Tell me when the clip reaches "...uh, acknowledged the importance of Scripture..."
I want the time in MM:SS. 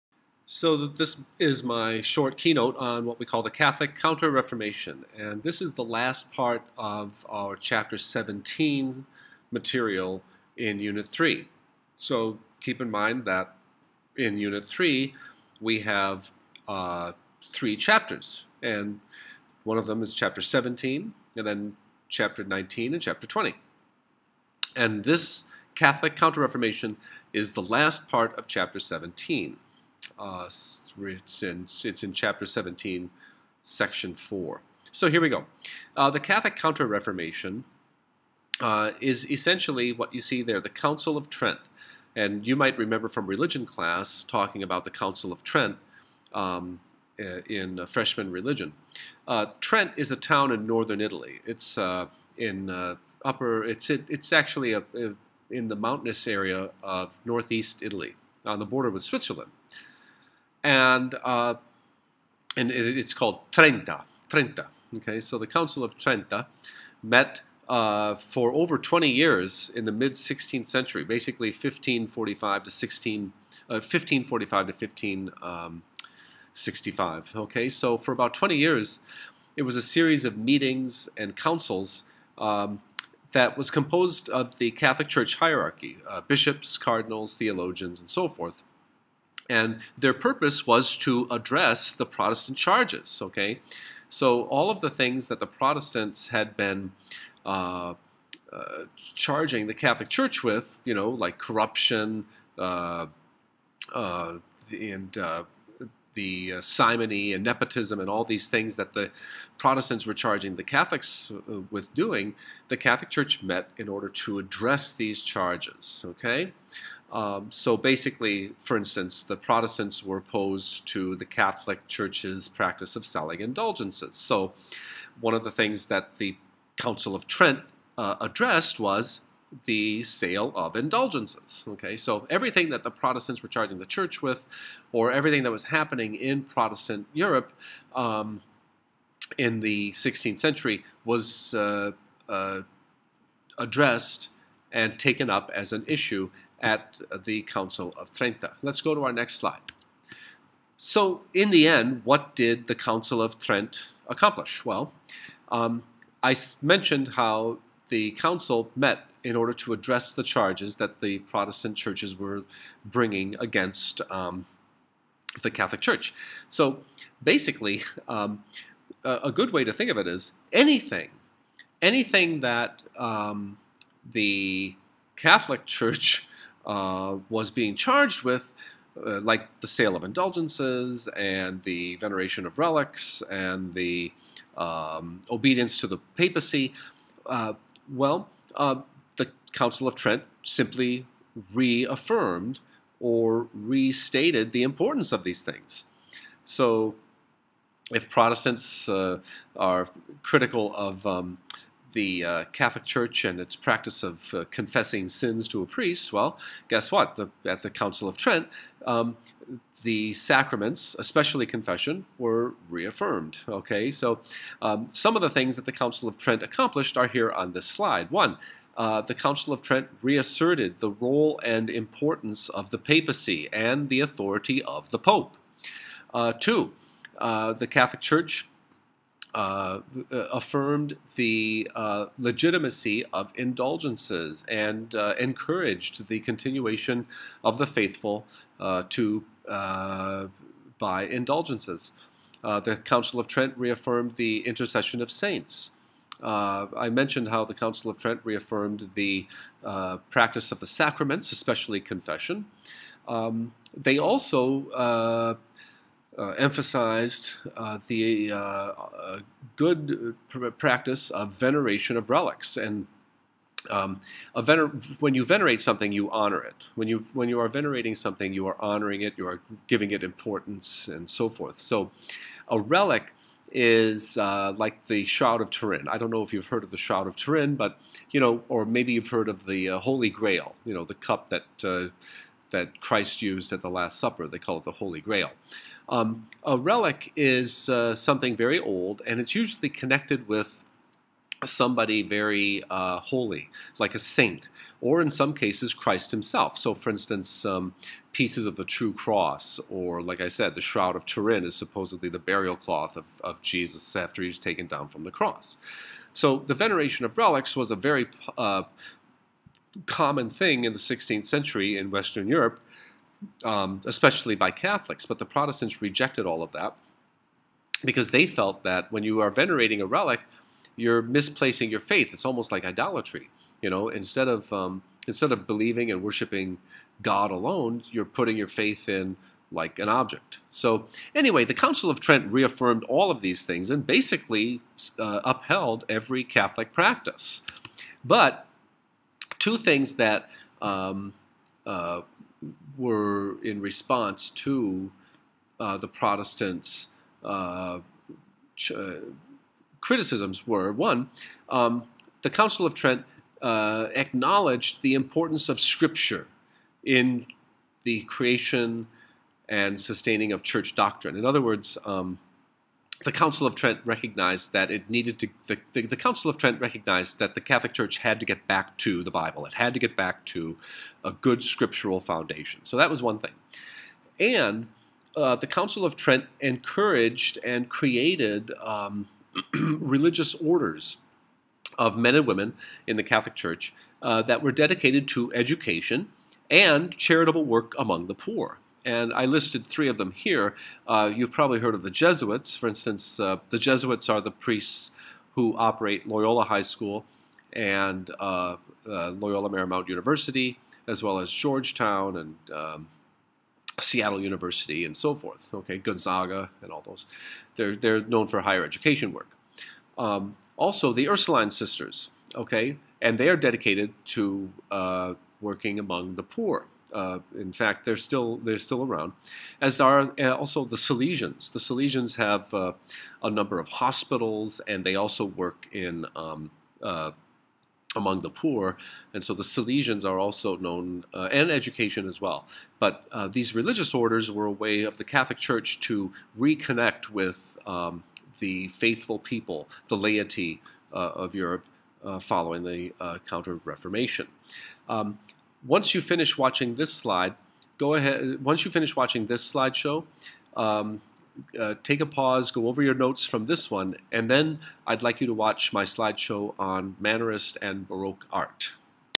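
05:53.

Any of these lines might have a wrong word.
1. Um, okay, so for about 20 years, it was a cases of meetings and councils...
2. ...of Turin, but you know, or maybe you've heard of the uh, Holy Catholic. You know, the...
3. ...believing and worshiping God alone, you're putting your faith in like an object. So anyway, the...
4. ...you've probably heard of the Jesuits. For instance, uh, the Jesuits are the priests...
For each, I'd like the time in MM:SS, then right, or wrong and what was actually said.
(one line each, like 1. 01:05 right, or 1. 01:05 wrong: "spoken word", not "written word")
1. 01:17 wrong: "series", not "cases"
2. 04:37 wrong: "Grail", not "Catholic"
3. 05:25 right
4. 06:31 right.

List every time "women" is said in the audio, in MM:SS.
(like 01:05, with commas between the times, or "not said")
06:22.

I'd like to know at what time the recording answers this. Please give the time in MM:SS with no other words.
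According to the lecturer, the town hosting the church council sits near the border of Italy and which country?
00:59.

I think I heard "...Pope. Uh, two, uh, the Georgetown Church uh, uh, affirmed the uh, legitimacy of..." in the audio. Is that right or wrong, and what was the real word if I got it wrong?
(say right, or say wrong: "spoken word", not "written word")
wrong: "Catholic", not "Georgetown".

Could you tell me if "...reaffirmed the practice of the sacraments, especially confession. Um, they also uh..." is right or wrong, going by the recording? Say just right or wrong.
right.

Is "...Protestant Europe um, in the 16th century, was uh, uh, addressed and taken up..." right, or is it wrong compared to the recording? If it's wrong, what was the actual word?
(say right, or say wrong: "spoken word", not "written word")
right.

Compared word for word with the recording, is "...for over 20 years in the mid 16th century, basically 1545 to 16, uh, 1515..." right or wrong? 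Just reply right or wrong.
wrong.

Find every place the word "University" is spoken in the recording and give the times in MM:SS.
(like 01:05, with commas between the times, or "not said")
06:39, 06:44.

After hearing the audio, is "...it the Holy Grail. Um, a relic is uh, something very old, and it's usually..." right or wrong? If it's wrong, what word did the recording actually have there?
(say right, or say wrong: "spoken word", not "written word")
right.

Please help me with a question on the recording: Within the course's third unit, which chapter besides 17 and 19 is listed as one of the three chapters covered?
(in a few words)
Chapter 20.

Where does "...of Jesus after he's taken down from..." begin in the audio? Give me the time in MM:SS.
05:03.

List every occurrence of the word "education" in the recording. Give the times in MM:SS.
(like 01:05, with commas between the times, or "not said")
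06:25, 06:48, 07:11.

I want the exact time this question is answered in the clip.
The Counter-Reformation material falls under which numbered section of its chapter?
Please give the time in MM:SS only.
00:33.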